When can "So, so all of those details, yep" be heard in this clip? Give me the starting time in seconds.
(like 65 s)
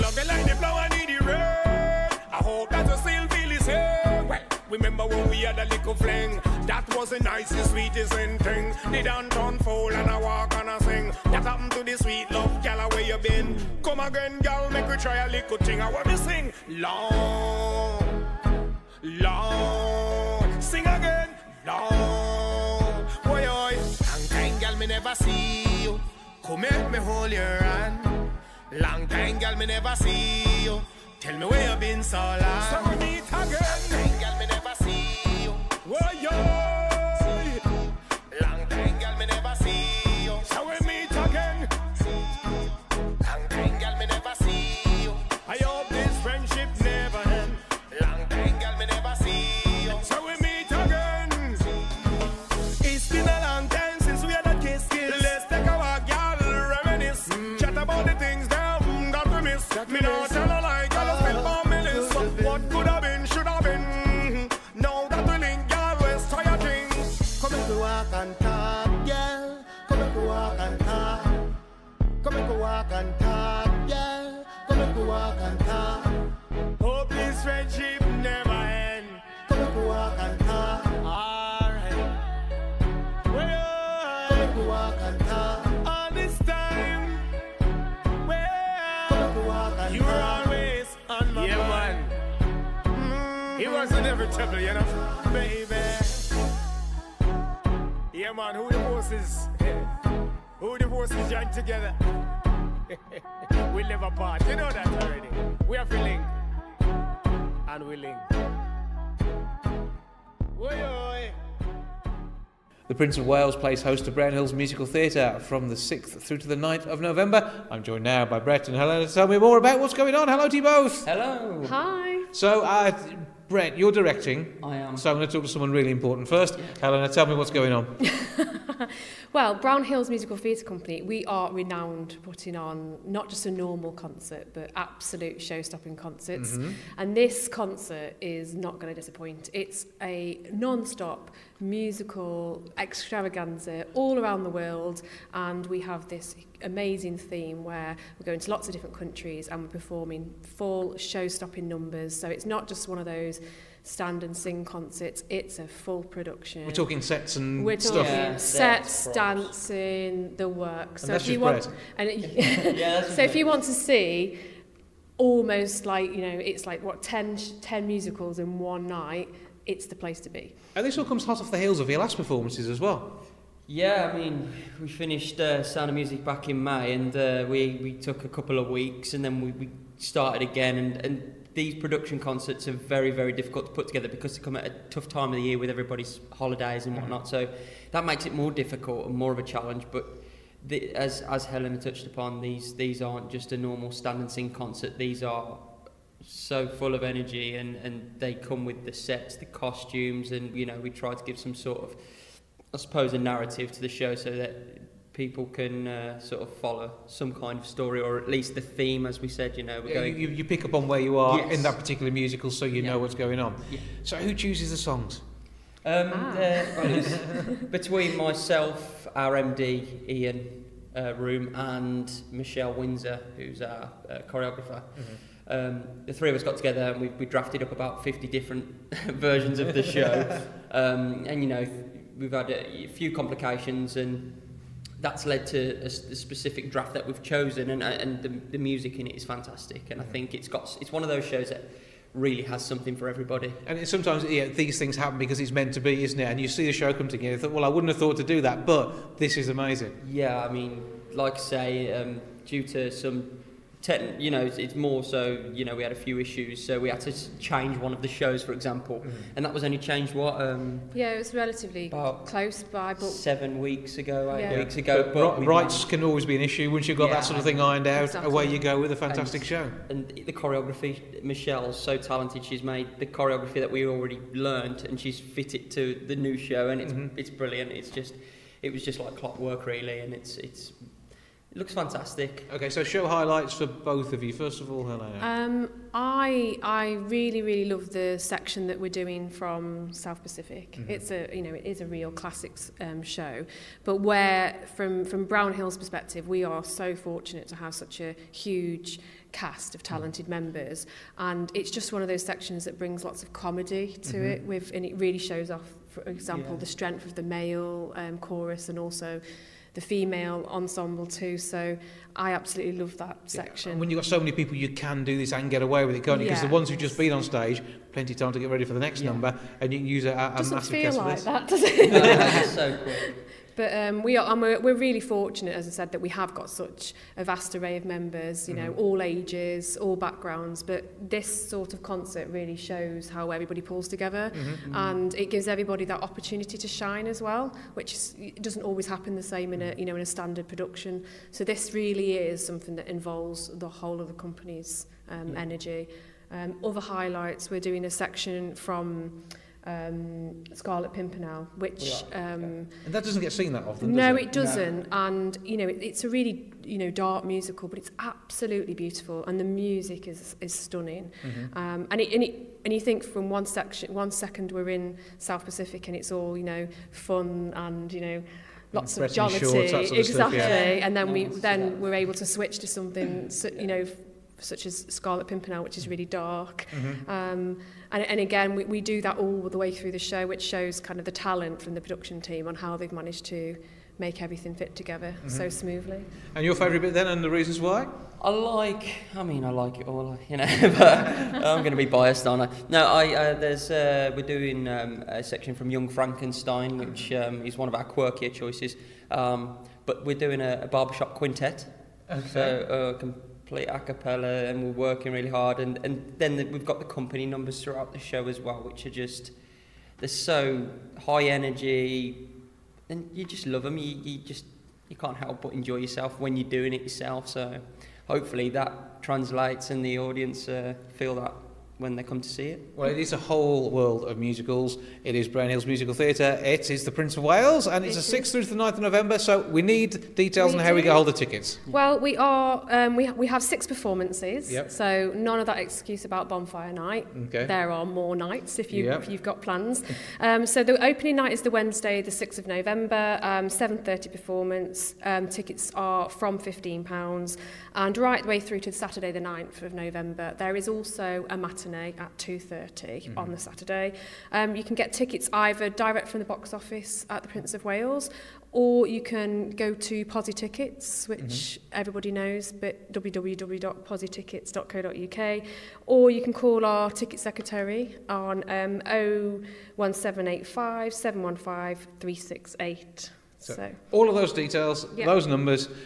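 473 s.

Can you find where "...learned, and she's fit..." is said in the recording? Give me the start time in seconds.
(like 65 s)
274 s.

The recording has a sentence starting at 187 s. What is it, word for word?
So that makes it more difficult and more of a challenge.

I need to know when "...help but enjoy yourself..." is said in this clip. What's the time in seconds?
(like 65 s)
415 s.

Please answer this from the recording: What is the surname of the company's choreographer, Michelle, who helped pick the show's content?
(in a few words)
Windsor.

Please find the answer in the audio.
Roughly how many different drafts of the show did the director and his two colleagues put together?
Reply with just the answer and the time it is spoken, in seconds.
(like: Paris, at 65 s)
50, at 228 s.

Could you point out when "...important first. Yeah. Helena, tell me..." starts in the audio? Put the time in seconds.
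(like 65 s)
125 s.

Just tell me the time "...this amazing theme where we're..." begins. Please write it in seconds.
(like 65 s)
146 s.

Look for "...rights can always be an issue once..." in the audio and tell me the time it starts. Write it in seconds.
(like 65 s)
265 s.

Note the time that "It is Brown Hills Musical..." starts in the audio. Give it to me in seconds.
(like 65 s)
425 s.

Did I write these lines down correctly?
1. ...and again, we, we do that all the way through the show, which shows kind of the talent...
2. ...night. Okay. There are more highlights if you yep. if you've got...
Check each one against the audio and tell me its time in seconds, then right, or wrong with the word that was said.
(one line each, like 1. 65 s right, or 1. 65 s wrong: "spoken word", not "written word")
1. 378 s right
2. 436 s wrong: "nights", not "highlights".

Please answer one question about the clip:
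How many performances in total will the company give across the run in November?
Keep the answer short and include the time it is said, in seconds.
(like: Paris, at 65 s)
6, at 433 s.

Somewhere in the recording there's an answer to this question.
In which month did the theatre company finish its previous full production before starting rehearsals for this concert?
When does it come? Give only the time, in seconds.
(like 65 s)
176 s.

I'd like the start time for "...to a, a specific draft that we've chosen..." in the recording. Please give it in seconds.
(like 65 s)
235 s.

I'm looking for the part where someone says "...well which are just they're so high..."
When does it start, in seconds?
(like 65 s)
408 s.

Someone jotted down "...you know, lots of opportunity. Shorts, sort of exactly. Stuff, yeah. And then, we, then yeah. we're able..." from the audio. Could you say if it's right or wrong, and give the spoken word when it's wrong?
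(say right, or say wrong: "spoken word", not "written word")
wrong: "jollity", not "opportunity".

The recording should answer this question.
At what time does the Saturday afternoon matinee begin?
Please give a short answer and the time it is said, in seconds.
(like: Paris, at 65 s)
2.30, at 452 s.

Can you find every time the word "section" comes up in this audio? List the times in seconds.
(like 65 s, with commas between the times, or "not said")
288 s, 302 s, 313 s, 347 s, 363 s, 395 s.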